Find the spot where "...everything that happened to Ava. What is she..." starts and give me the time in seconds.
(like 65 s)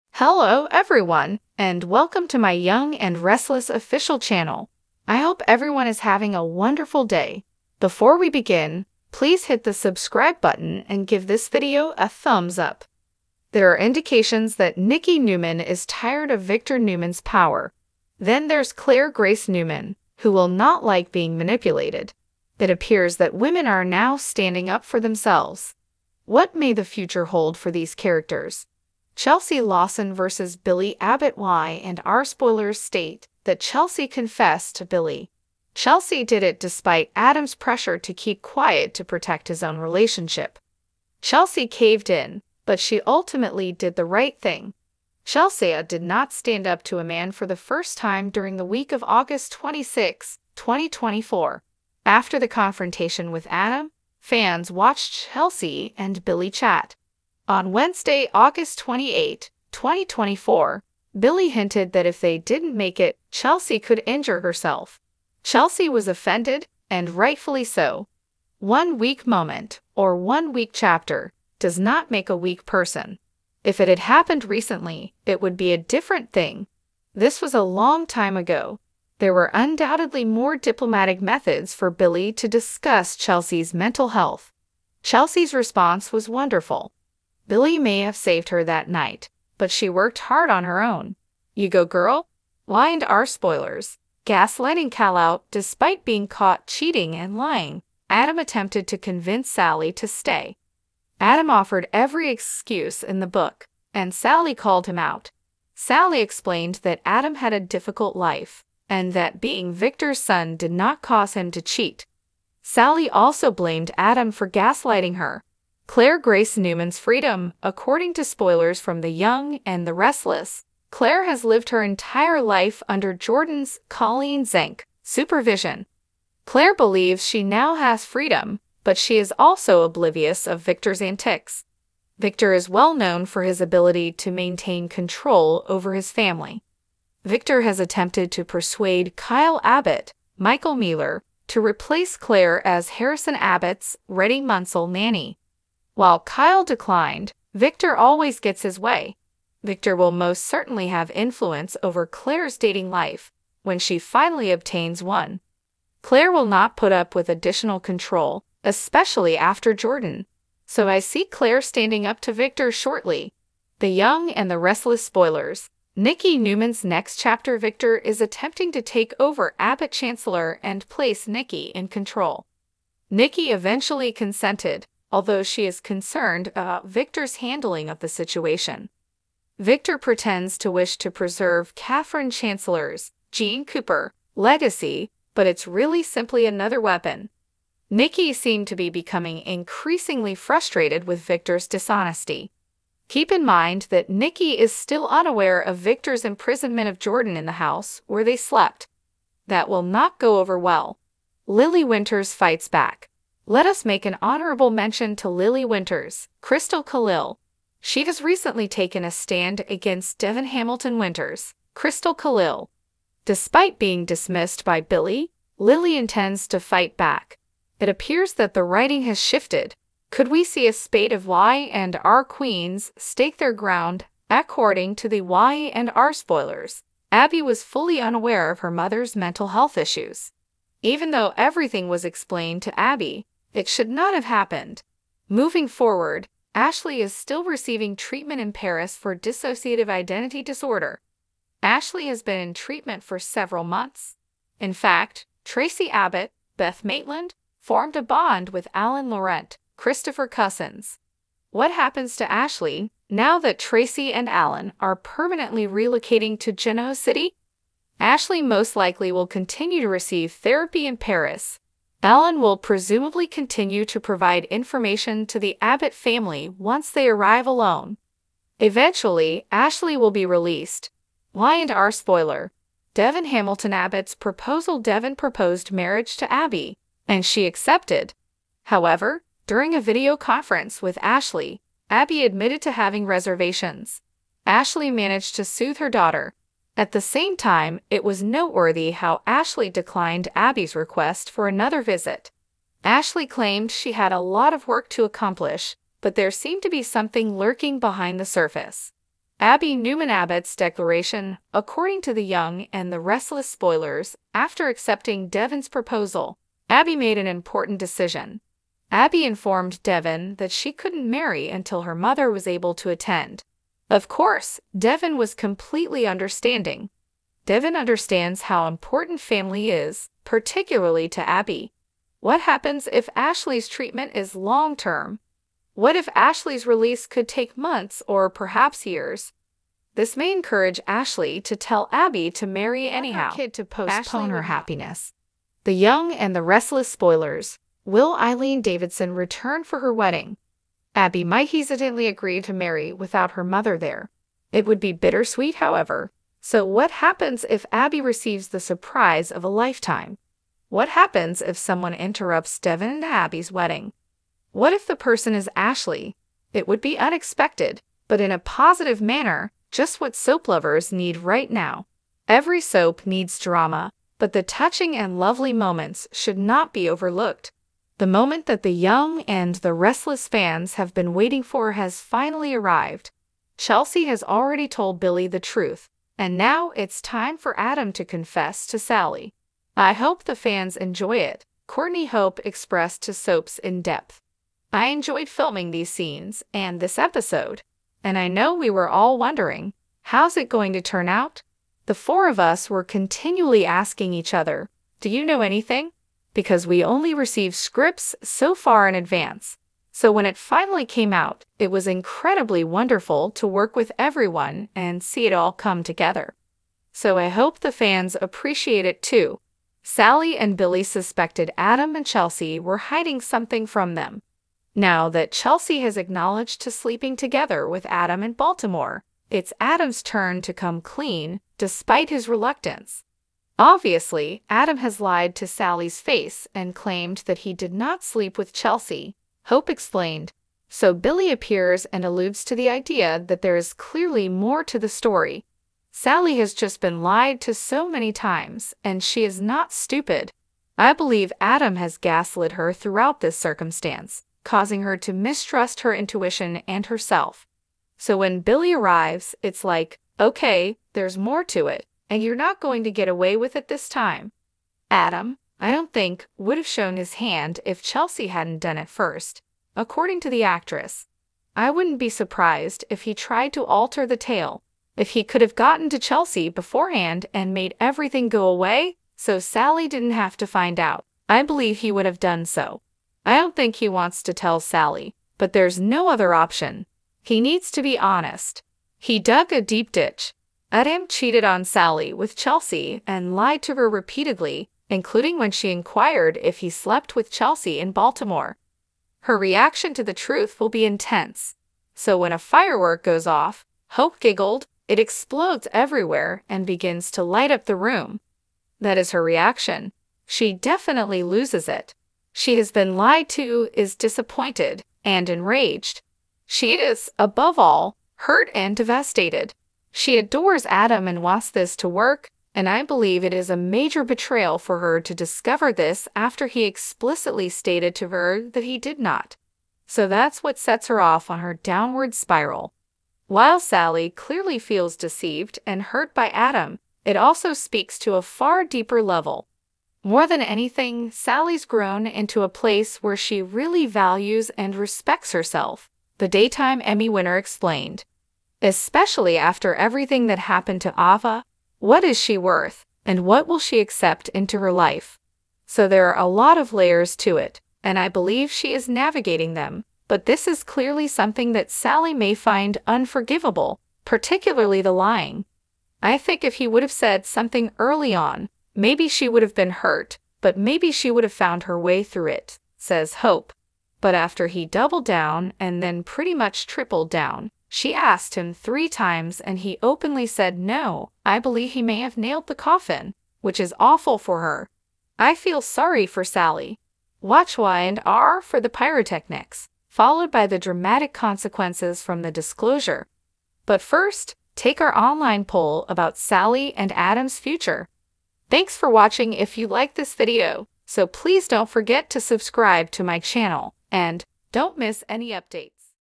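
539 s.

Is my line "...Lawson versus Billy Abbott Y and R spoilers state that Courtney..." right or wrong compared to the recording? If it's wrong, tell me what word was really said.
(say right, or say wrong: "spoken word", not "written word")
wrong: "Chelsea", not "Courtney".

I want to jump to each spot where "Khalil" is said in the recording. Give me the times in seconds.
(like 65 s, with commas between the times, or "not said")
206 s, 212 s.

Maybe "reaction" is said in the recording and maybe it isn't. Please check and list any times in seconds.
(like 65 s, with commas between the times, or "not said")
489 s, 499 s.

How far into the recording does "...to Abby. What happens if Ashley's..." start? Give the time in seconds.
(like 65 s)
321 s.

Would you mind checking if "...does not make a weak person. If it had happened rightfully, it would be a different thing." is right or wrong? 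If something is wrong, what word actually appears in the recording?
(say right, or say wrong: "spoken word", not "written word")
wrong: "recently", not "rightfully".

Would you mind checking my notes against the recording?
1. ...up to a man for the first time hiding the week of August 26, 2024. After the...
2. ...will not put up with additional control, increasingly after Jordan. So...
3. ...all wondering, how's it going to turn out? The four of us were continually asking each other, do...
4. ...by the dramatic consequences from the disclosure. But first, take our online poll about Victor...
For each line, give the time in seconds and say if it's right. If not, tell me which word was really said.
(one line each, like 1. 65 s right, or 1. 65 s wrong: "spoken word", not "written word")
1. 46 s wrong: "during", not "hiding"
2. 156 s wrong: "especially", not "increasingly"
3. 388 s right
4. 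580 s wrong: "Sally", not "Victor".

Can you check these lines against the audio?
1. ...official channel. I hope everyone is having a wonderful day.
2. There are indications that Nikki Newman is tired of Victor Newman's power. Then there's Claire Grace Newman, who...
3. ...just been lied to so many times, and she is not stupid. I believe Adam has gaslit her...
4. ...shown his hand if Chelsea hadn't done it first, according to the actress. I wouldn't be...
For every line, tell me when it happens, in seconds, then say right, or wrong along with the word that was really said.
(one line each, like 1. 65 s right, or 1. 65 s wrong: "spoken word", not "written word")
1. 3 s right
2. 13 s right
3. 436 s right
4. 456 s right.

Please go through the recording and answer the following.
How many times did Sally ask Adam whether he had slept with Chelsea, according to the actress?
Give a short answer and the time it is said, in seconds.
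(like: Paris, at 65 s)
3, at 568 s.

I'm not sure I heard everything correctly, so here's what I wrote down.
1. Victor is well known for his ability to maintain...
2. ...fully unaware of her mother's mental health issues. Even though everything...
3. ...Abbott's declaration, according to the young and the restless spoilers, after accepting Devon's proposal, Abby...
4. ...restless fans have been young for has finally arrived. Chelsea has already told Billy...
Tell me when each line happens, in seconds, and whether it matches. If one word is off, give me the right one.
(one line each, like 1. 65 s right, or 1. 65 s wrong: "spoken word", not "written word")
1. 132 s right
2. 227 s right
3. 300 s right
4. 369 s wrong: "waiting", not "young".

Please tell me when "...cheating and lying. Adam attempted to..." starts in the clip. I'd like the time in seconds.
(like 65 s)
96 s.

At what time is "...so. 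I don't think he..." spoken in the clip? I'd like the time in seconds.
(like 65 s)
472 s.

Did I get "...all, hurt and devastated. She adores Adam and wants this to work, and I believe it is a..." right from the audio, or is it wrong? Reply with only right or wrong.
right.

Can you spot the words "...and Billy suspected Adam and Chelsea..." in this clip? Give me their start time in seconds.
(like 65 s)
410 s.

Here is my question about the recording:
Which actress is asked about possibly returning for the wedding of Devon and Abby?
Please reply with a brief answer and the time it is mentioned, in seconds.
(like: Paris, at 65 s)
Eileen Davidson, at 338 s.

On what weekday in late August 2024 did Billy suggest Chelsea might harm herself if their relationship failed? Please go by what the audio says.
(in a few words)
Wednesday.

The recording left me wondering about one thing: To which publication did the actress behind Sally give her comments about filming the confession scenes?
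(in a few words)
Soaps in Depth.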